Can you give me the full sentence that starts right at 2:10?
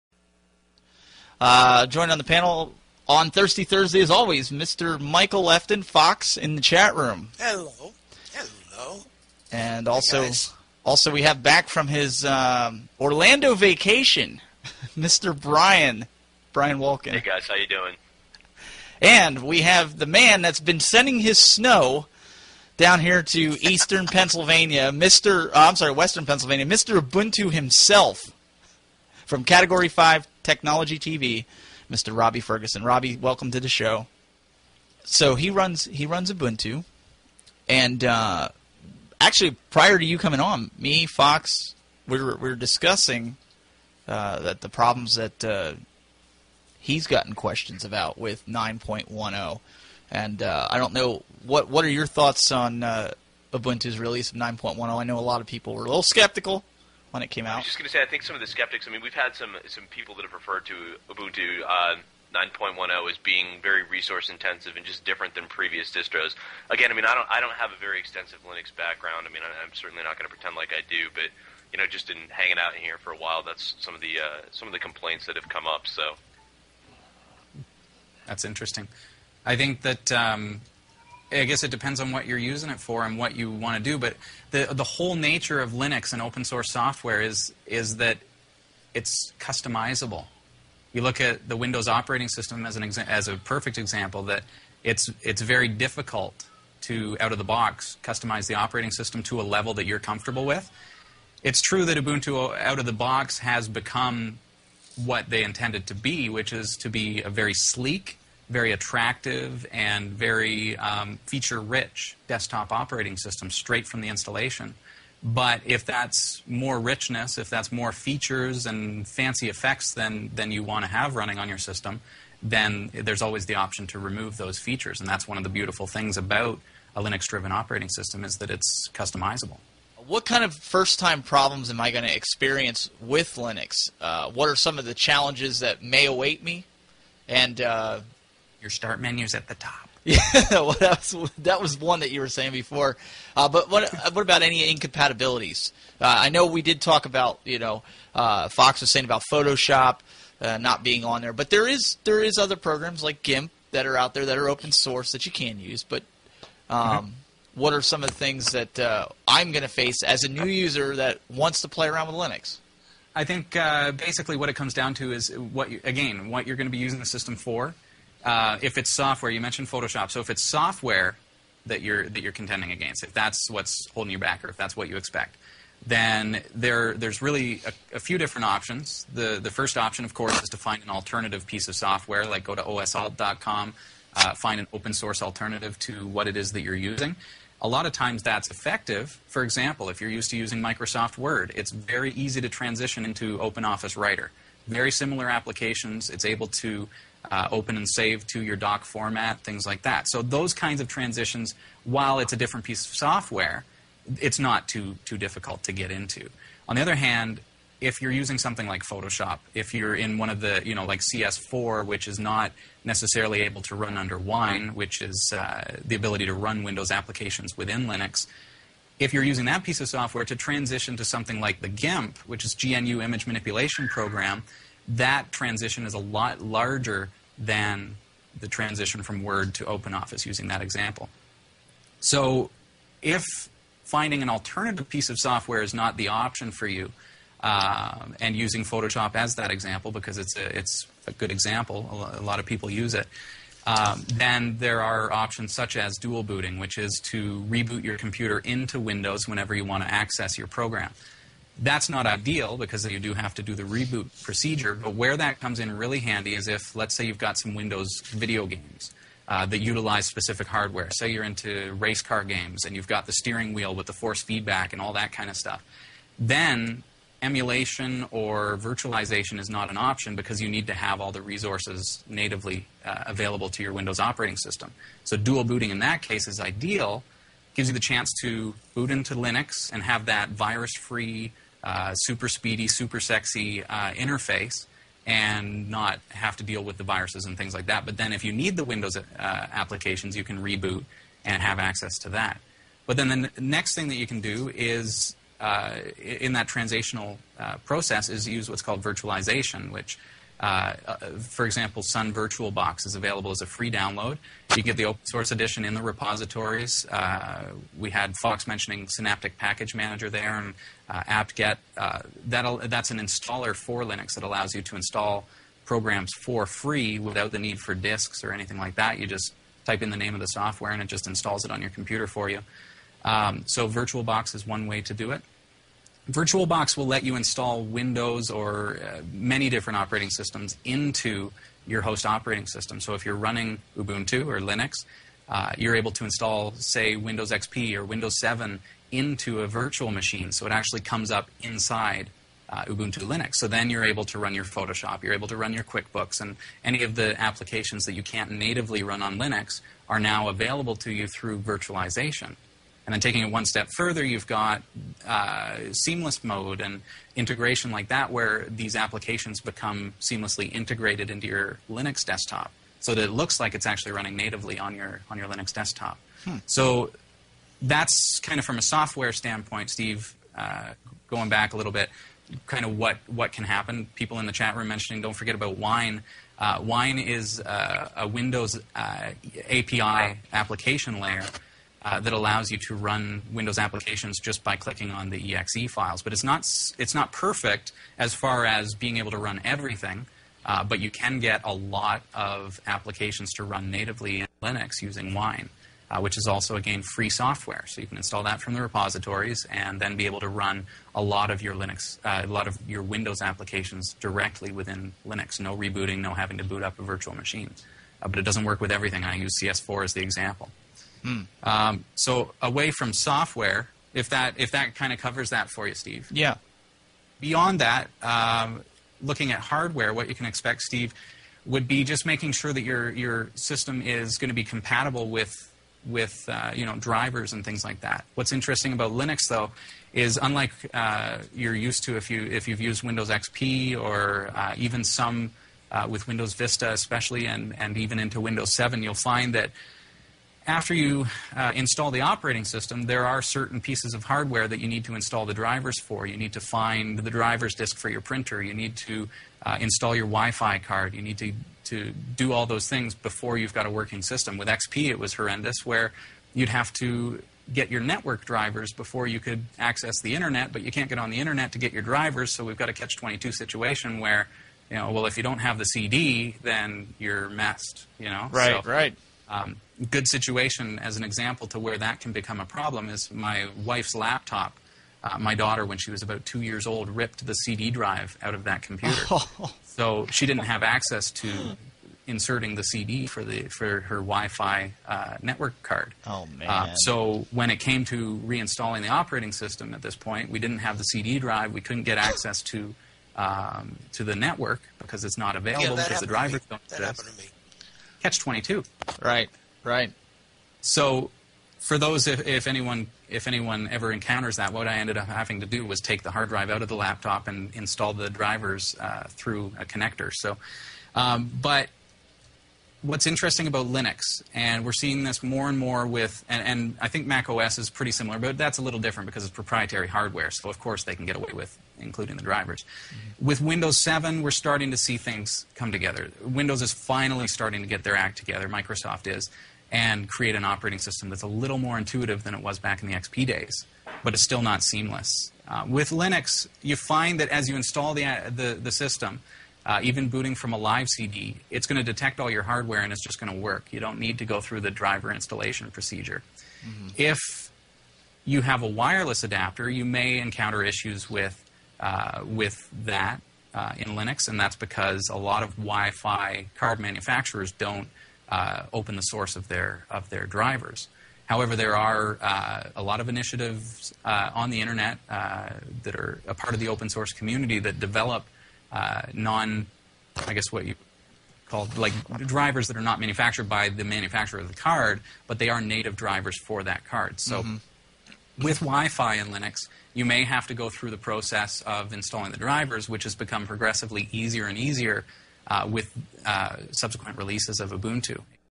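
What kind of first-time problems am I going to experience with Linux?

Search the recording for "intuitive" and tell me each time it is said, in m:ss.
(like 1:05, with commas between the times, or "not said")
8:51.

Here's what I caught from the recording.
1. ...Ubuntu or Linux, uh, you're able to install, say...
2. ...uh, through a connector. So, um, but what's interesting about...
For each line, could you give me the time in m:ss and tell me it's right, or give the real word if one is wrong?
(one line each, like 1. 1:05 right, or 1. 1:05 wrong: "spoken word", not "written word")
1. 5:33 right
2. 8:28 right.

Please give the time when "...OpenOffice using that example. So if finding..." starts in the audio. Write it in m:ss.
3:49.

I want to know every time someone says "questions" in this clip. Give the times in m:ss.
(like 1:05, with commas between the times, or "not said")
0:47.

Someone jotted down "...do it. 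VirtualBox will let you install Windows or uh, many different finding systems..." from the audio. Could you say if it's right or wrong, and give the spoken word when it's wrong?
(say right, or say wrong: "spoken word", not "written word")
wrong: "operating", not "finding".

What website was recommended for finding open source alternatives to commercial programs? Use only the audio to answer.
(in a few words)
osalt.com.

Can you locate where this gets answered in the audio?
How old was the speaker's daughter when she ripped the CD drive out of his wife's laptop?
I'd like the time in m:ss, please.
7:56.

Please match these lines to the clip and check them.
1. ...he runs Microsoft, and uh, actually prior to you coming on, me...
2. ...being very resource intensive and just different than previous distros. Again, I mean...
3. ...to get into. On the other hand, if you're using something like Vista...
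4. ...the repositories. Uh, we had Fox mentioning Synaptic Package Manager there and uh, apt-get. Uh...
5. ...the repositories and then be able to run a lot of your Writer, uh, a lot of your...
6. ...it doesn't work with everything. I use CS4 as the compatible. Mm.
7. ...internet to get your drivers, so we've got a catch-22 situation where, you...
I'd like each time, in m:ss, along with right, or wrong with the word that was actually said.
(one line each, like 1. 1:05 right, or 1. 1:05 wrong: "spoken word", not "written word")
1. 0:35 wrong: "Ubuntu", not "Microsoft"
2. 1:03 right
3. 3:25 wrong: "Photoshop", not "Vista"
4. 5:05 right
5. 6:38 wrong: "Linux", not "Writer"
6. 6:48 wrong: "example", not "compatible"
7. 7:41 right.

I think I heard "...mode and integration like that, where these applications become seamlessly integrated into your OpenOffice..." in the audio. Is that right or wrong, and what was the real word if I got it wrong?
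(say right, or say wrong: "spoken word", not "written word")
wrong: "Linux", not "OpenOffice".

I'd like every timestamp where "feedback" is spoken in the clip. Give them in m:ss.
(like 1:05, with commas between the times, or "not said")
4:24.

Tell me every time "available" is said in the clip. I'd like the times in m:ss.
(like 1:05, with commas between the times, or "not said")
4:33, 5:02, 5:50, 8:15.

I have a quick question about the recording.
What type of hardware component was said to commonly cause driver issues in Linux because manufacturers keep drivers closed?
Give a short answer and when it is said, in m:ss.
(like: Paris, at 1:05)
wireless adapter, at 9:08.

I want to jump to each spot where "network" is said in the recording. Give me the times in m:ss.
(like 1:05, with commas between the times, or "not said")
7:37, 8:05, 8:14.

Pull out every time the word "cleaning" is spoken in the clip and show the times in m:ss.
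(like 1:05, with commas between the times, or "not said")
not said.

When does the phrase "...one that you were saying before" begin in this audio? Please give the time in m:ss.
2:21.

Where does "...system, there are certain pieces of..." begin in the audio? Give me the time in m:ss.
7:22.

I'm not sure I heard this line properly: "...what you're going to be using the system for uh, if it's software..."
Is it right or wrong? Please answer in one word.
right.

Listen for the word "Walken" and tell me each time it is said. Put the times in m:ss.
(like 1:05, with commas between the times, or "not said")
0:16.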